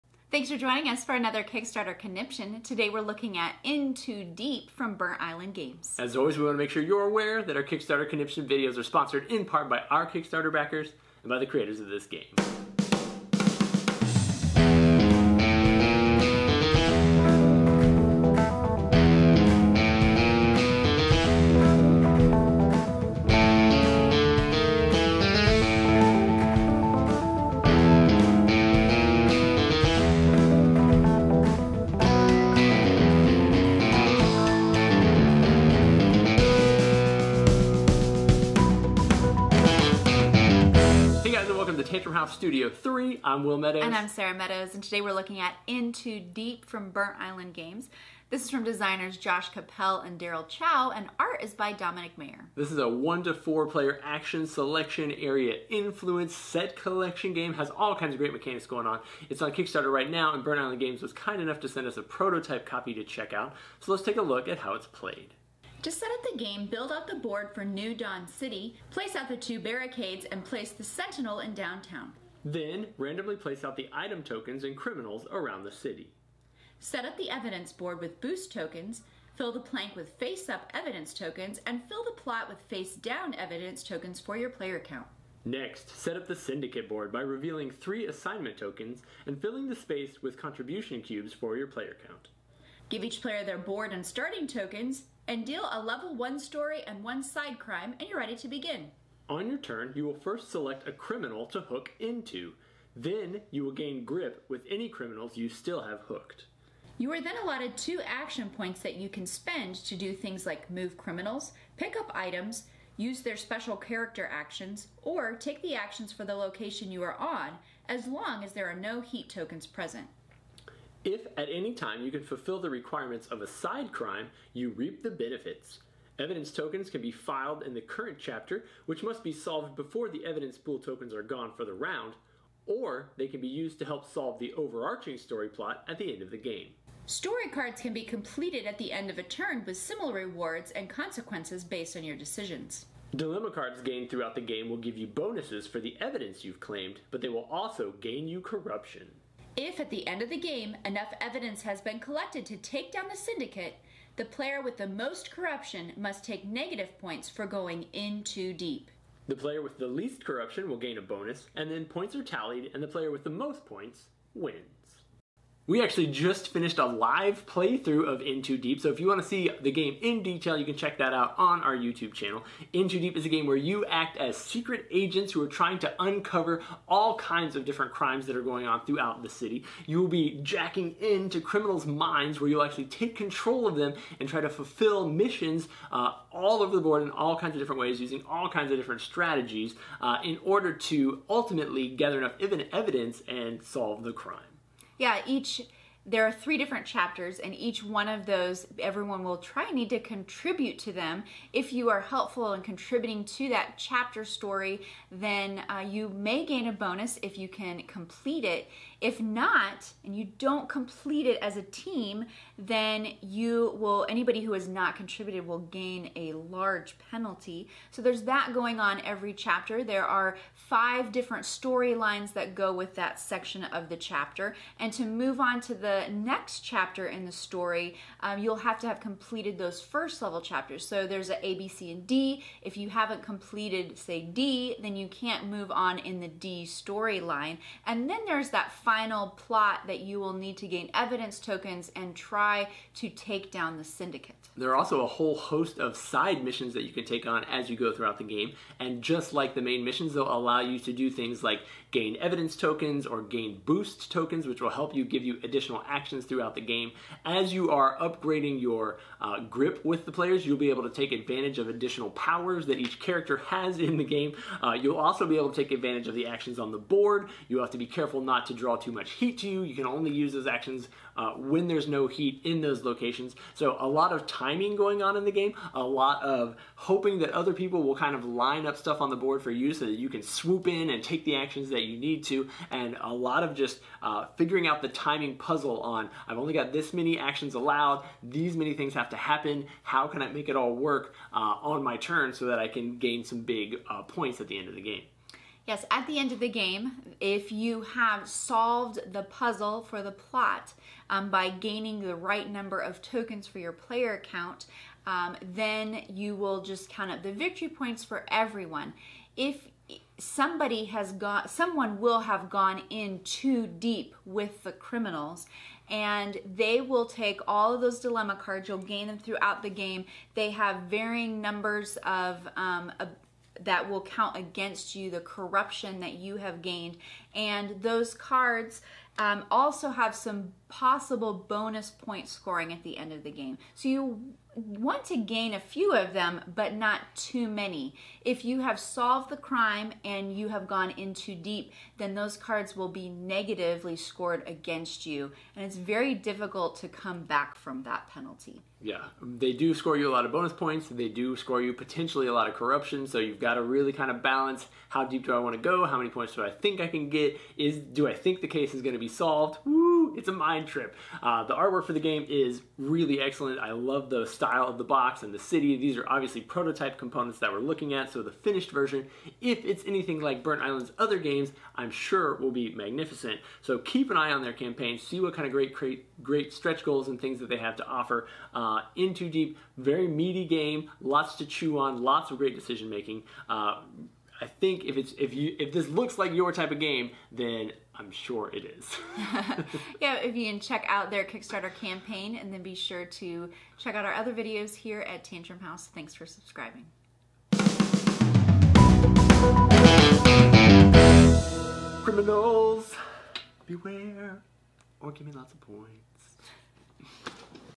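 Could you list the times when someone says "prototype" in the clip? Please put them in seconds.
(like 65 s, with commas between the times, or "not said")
62 s, 366 s.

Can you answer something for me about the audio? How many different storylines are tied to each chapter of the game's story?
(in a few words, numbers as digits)
5.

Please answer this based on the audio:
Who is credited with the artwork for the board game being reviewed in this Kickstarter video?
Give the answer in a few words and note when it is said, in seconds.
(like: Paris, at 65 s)
Dominik Mayer, at 51 s.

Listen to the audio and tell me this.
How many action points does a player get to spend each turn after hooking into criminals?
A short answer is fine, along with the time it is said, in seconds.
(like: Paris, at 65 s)
2, at 107 s.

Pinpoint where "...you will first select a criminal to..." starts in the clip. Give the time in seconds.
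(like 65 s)
99 s.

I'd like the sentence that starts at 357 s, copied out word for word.
Is do I think the case is going to be solved.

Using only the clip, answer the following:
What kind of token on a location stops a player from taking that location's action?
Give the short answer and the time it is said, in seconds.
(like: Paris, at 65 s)
heat tokens, at 118 s.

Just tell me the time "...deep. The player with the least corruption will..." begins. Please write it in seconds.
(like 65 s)
158 s.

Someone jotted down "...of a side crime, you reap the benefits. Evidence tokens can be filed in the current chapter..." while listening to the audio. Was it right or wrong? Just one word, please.
right.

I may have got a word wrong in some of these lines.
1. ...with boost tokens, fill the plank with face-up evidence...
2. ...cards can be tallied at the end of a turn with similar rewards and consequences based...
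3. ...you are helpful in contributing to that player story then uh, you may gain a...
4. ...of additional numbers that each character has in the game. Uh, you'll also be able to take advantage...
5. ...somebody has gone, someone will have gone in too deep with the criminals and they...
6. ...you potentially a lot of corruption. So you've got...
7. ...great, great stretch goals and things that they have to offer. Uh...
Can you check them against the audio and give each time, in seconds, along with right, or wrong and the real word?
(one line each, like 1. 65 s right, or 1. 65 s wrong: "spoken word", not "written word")
1. 77 s right
2. 137 s wrong: "completed", not "tallied"
3. 201 s wrong: "chapter", not "player"
4. 261 s wrong: "powers", not "numbers"
5. 310 s right
6. 351 s right
7. 375 s right.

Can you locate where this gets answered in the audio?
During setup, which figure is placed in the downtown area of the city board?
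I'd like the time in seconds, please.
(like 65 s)
70 s.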